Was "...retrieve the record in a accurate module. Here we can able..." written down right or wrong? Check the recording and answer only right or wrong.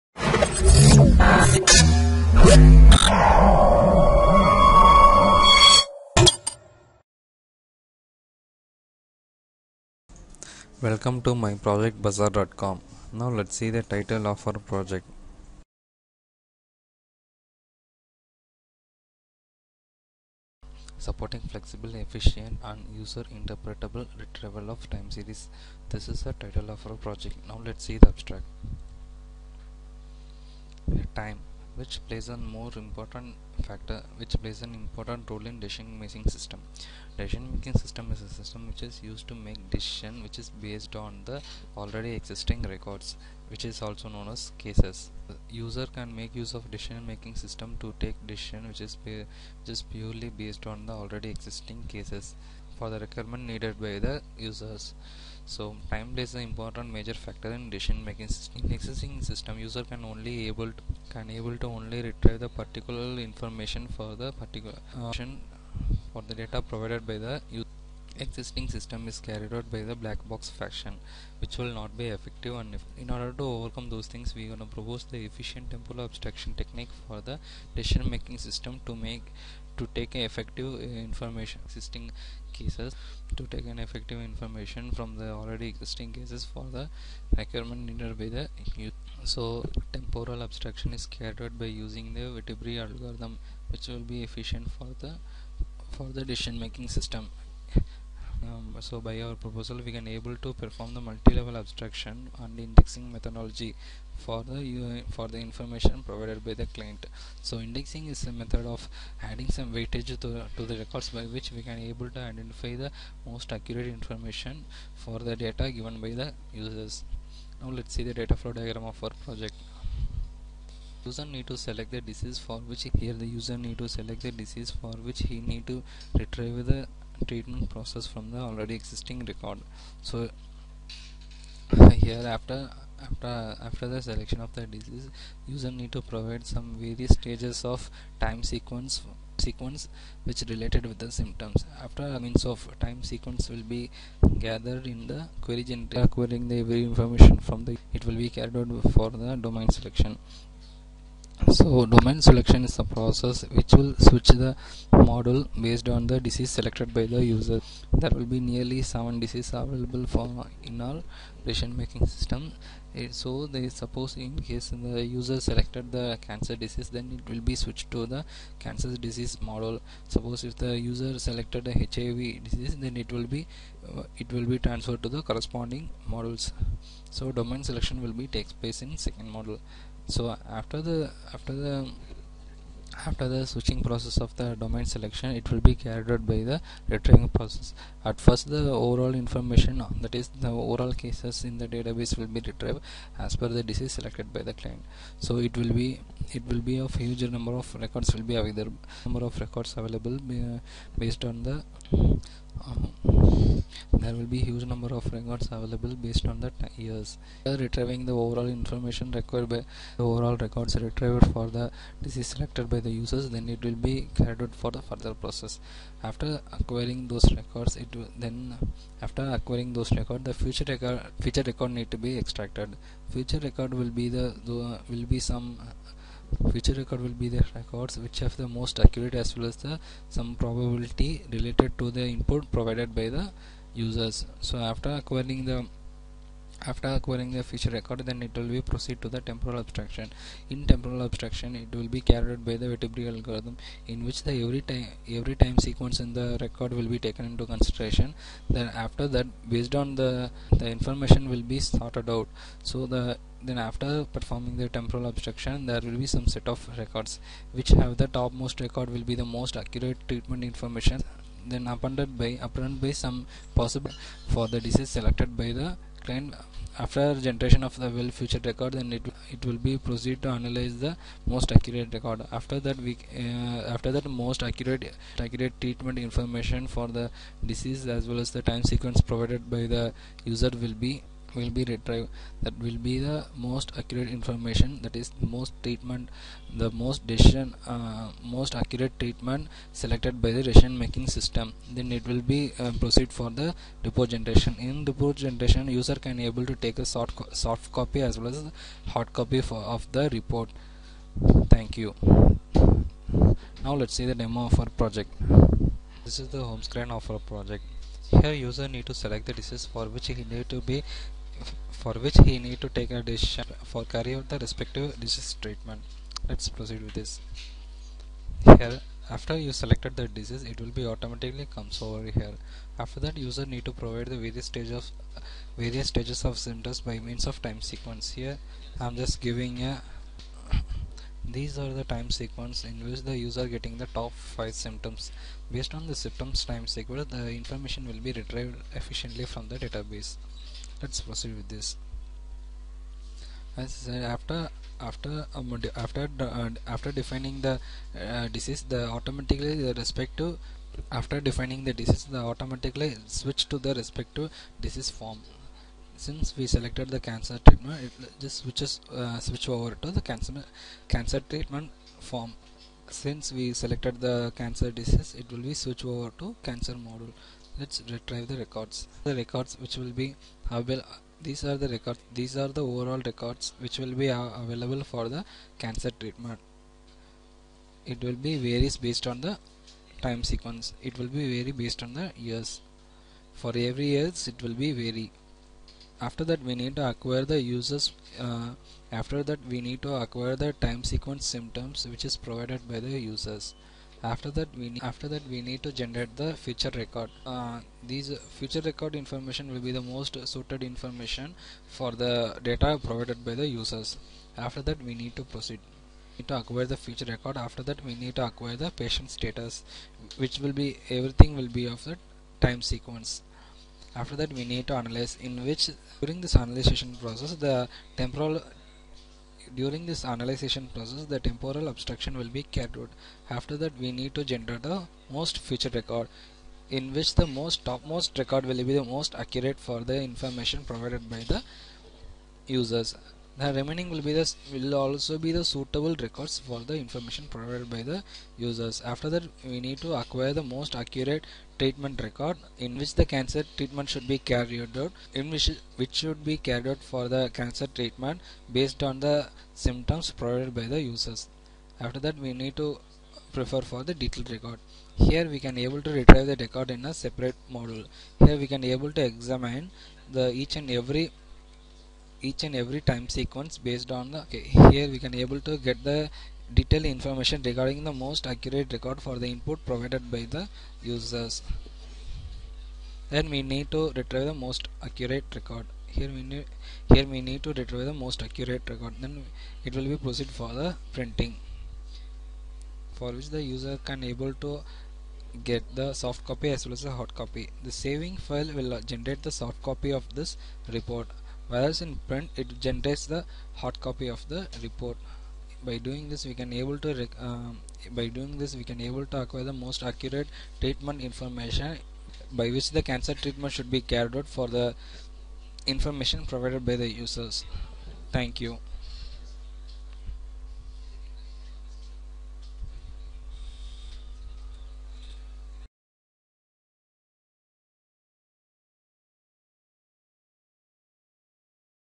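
wrong.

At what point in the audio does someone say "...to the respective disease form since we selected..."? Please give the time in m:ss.
5:53.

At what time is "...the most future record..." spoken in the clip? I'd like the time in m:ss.
7:04.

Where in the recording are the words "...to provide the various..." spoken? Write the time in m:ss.
5:23.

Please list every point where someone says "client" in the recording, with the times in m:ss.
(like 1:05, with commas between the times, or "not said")
1:46, 3:14, 4:26.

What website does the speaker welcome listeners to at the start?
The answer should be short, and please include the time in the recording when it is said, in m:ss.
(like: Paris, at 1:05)
bazaar.com, at 0:12.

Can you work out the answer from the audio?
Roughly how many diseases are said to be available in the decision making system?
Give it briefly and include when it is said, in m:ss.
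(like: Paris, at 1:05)
7, at 2:38.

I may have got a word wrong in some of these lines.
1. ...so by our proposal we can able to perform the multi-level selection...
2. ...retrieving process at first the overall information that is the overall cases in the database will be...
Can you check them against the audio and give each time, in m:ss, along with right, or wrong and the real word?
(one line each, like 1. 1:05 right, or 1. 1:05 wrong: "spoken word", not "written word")
1. 1:38 wrong: "abstraction", not "selection"
2. 3:06 right.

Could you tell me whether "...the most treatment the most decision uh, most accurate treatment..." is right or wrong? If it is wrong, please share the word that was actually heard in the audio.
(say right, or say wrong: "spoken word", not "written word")
right.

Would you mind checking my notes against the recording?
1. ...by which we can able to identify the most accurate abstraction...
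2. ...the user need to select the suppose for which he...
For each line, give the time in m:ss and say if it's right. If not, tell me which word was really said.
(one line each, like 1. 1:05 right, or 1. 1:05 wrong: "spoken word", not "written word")
1. 1:51 wrong: "information", not "abstraction"
2. 2:03 wrong: "disease", not "suppose".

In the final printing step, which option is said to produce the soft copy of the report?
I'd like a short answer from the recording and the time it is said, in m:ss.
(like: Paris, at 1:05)
saving file, at 8:07.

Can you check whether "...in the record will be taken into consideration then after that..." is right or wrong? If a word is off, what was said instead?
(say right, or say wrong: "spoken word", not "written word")
right.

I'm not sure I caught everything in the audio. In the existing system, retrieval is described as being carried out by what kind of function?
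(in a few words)
black box function.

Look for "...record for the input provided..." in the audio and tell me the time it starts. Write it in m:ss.
7:48.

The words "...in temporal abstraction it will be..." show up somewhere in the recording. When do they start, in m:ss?
4:00.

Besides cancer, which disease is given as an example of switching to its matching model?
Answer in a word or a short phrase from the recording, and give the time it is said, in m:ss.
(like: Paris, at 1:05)
HIV, at 2:51.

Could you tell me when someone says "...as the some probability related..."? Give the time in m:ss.
3:49.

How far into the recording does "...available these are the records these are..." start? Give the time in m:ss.
6:10.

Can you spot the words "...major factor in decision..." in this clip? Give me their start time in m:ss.
0:56.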